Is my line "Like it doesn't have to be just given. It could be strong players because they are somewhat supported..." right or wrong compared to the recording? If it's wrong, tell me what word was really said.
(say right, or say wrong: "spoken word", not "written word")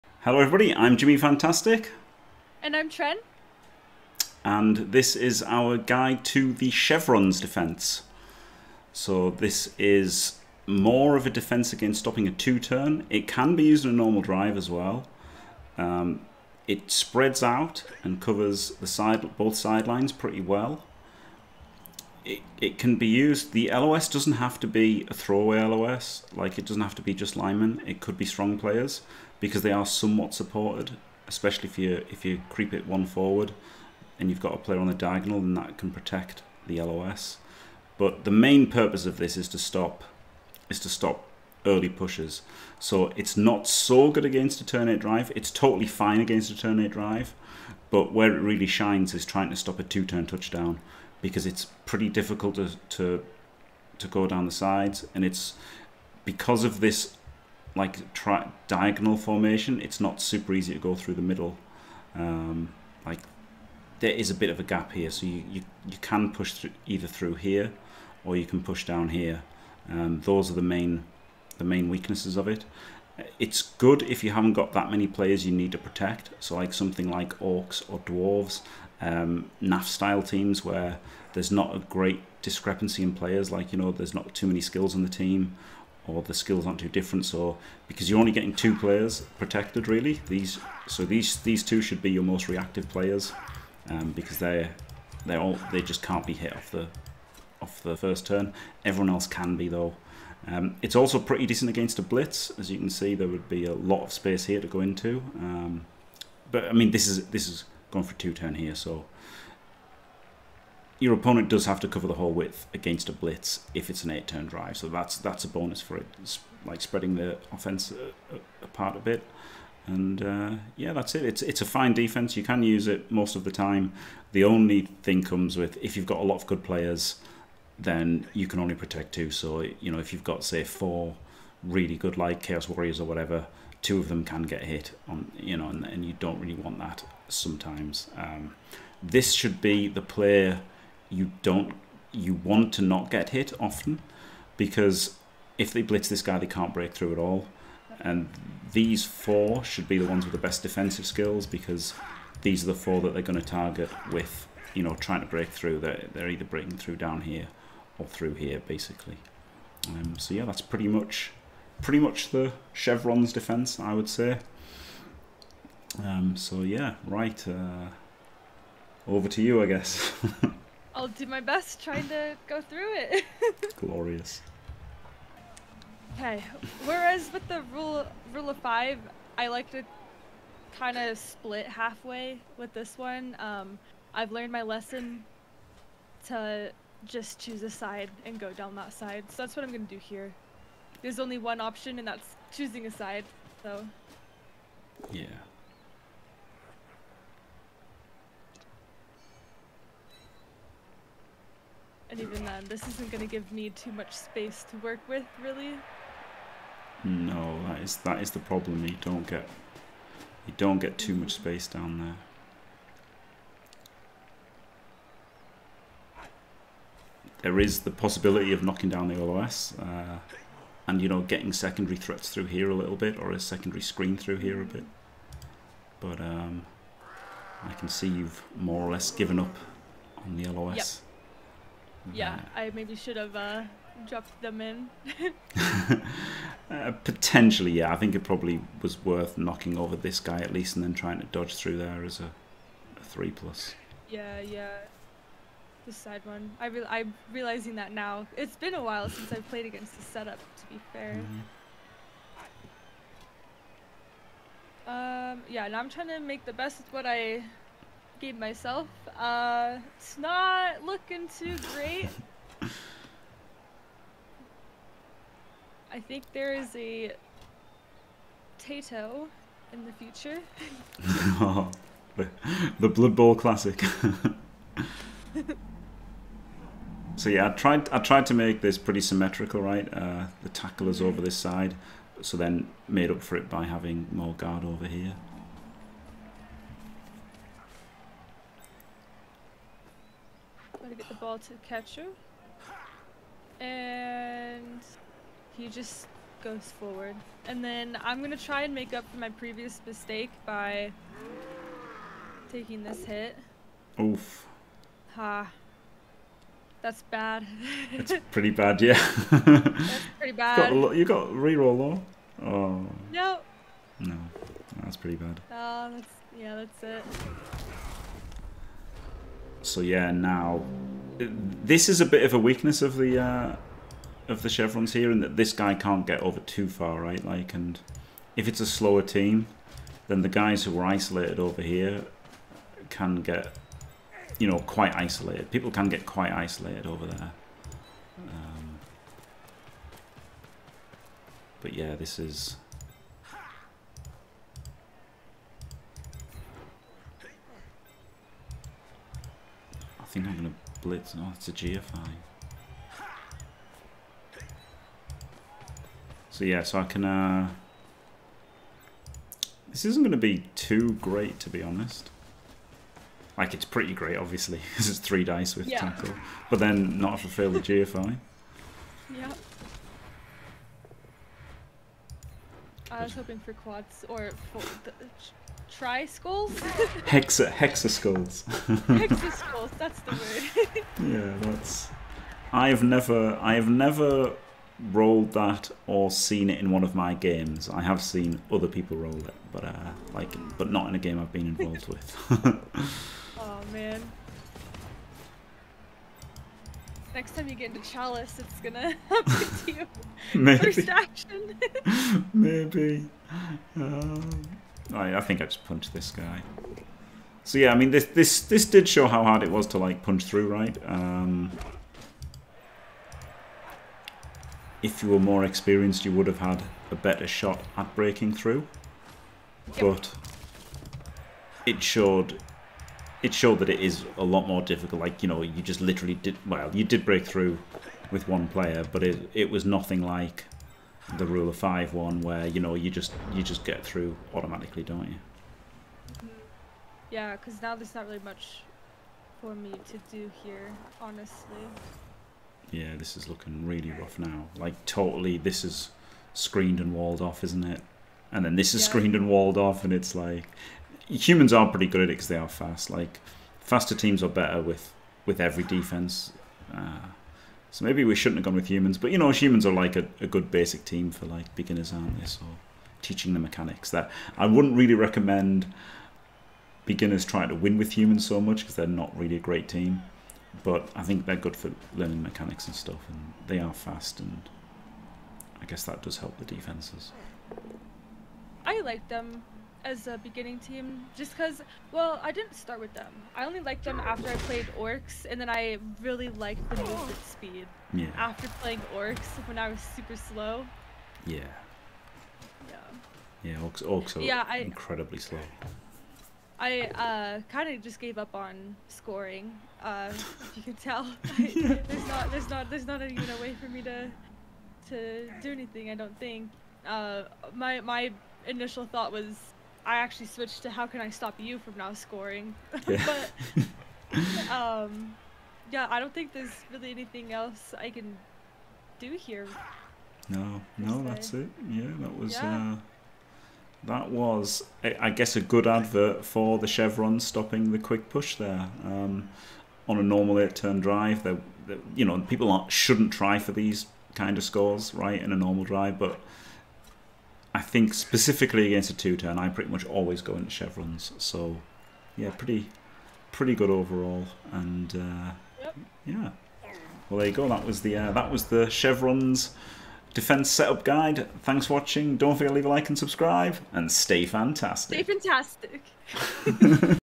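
wrong: "linemen", not "given".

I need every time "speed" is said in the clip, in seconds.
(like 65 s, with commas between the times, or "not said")
487 s.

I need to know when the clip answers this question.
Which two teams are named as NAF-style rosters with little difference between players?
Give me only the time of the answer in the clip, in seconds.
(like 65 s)
77 s.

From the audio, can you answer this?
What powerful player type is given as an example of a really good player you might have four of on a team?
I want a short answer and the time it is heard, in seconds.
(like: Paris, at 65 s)
Chaos Warriors, at 132 s.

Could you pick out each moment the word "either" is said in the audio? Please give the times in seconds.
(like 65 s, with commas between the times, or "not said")
66 s, 156 s.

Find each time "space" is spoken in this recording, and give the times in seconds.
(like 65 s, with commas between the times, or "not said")
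104 s, 204 s, 211 s.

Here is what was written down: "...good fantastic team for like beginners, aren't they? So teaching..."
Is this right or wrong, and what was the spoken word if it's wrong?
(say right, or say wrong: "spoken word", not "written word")
wrong: "basic", not "fantastic".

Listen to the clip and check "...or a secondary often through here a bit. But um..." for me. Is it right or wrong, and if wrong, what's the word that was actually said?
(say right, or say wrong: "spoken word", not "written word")
wrong: "screen", not "often".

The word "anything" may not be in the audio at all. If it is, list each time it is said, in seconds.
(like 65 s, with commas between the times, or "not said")
505 s, 516 s.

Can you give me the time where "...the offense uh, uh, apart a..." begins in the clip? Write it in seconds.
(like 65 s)
117 s.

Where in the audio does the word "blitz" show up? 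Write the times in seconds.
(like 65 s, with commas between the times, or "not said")
102 s, 113 s, 145 s, 350 s.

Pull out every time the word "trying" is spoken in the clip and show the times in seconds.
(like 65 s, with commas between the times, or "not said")
49 s, 154 s, 171 s, 240 s, 255 s, 467 s.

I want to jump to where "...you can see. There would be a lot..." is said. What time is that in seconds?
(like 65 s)
102 s.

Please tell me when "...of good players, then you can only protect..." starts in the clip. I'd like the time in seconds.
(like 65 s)
126 s.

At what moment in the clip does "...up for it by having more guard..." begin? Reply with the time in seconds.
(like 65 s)
283 s.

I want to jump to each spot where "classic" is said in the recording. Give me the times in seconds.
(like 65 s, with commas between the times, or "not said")
273 s.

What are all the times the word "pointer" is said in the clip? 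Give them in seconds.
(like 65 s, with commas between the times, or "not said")
not said.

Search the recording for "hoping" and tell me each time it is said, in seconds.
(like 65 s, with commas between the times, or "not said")
373 s.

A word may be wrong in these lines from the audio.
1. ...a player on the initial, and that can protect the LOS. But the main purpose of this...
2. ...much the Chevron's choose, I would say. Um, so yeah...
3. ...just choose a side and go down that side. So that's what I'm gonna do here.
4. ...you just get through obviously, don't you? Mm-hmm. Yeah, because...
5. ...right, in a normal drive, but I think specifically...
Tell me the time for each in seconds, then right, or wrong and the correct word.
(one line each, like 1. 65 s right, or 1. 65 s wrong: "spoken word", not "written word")
1. 34 s wrong: "diagonal", not "initial"
2. 161 s wrong: "defense", not "choose"
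3. 187 s right
4. 433 s wrong: "automatically", not "obviously"
5. 534 s right.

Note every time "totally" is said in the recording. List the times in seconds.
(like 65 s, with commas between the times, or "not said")
45 s, 444 s.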